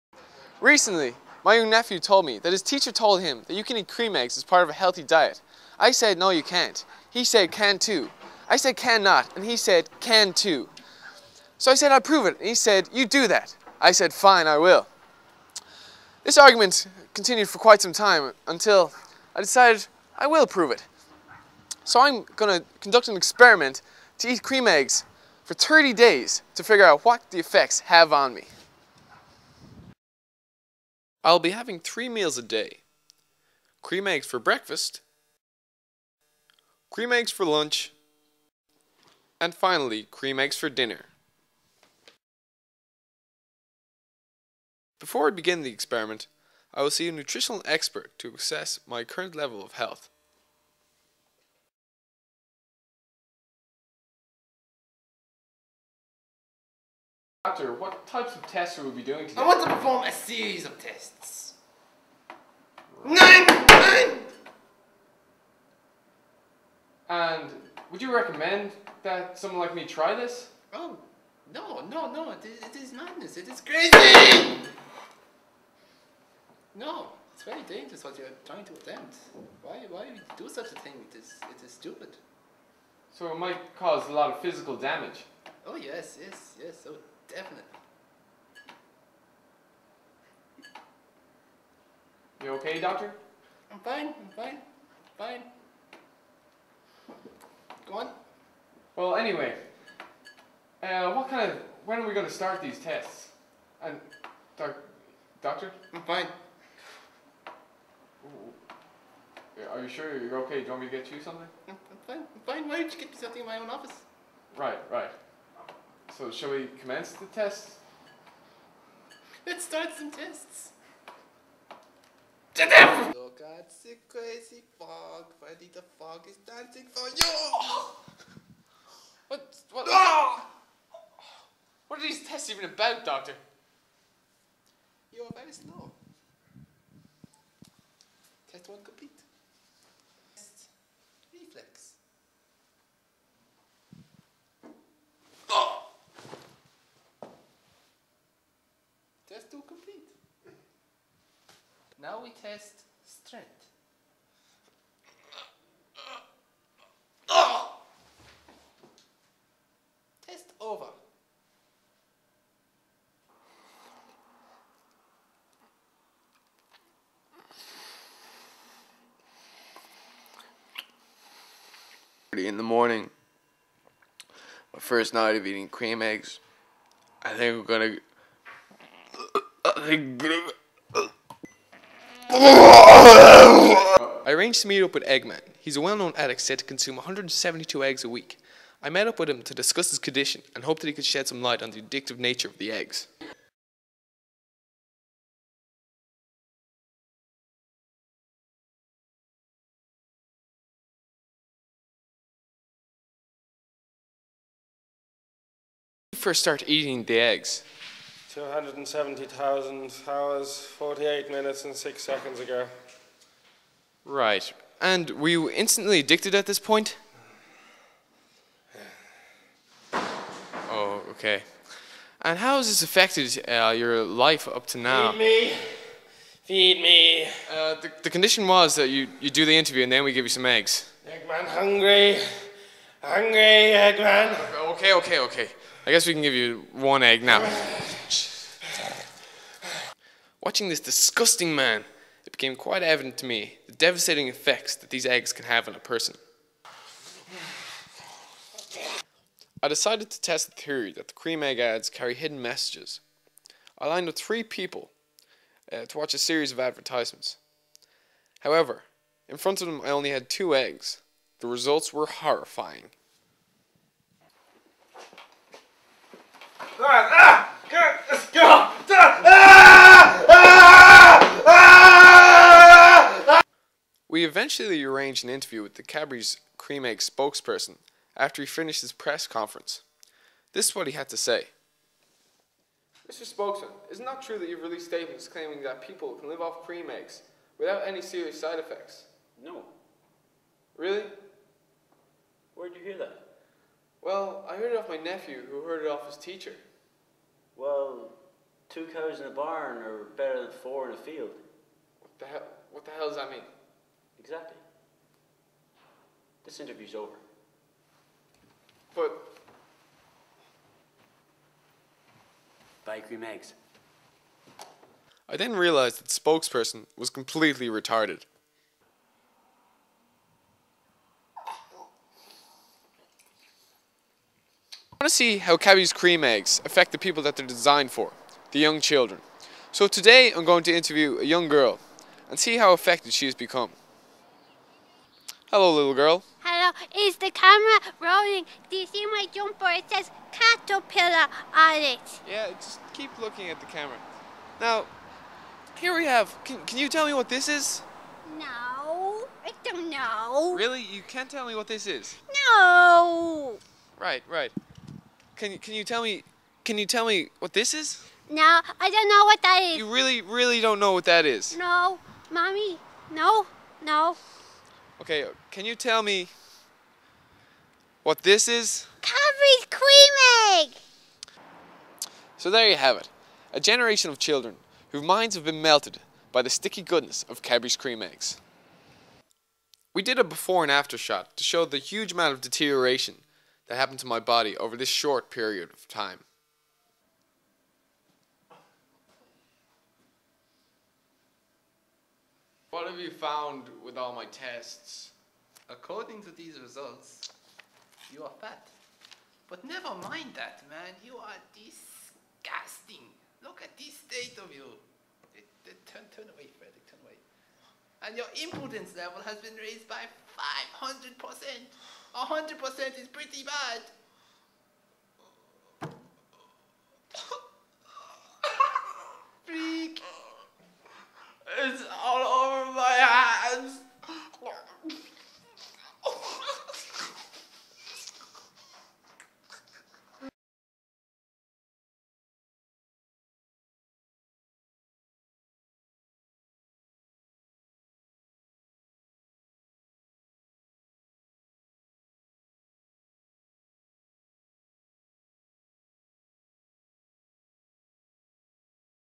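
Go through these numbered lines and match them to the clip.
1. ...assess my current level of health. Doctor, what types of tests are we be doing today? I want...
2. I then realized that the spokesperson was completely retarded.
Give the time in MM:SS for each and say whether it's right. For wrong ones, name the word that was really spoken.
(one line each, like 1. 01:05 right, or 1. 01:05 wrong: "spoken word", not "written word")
1. 00:48 right
2. 05:15 right.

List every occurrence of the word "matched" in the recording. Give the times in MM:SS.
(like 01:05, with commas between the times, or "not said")
not said.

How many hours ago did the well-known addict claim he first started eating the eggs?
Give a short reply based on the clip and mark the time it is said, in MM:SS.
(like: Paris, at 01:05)
270,000 hours, at 03:28.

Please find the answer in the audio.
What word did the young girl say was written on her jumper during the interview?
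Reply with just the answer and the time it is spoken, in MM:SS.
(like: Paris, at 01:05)
Caterpillar, at 05:40.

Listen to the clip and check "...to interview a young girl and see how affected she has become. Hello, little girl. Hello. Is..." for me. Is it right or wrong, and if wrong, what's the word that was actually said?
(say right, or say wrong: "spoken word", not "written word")
right.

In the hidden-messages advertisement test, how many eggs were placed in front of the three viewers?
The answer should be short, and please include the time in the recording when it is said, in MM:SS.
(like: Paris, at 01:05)
2, at 04:20.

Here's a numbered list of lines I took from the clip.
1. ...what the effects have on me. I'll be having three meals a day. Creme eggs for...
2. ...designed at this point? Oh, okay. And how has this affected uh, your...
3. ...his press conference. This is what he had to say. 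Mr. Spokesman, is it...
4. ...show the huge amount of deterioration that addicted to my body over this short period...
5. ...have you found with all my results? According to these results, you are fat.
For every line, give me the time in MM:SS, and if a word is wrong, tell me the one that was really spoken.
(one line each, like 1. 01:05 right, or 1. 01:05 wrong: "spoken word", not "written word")
1. 00:27 right
2. 03:35 wrong: "addicted", not "designed"
3. 04:38 right
4. 06:21 wrong: "happened", not "addicted"
5. 06:32 wrong: "tests", not "results".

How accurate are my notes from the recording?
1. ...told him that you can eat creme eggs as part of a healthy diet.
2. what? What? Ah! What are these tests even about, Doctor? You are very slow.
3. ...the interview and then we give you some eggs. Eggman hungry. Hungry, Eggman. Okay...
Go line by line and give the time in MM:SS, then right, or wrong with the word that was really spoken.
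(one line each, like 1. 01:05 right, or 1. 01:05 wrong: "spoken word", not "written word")
1. 00:02 right
2. 02:09 right
3. 03:49 right.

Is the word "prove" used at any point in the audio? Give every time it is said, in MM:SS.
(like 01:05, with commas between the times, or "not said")
00:11, 00:20.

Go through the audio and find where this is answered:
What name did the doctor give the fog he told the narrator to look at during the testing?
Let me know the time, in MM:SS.
02:05.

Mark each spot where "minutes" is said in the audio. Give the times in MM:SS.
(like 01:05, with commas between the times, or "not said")
03:31.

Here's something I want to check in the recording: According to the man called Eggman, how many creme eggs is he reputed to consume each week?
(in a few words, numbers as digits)
172.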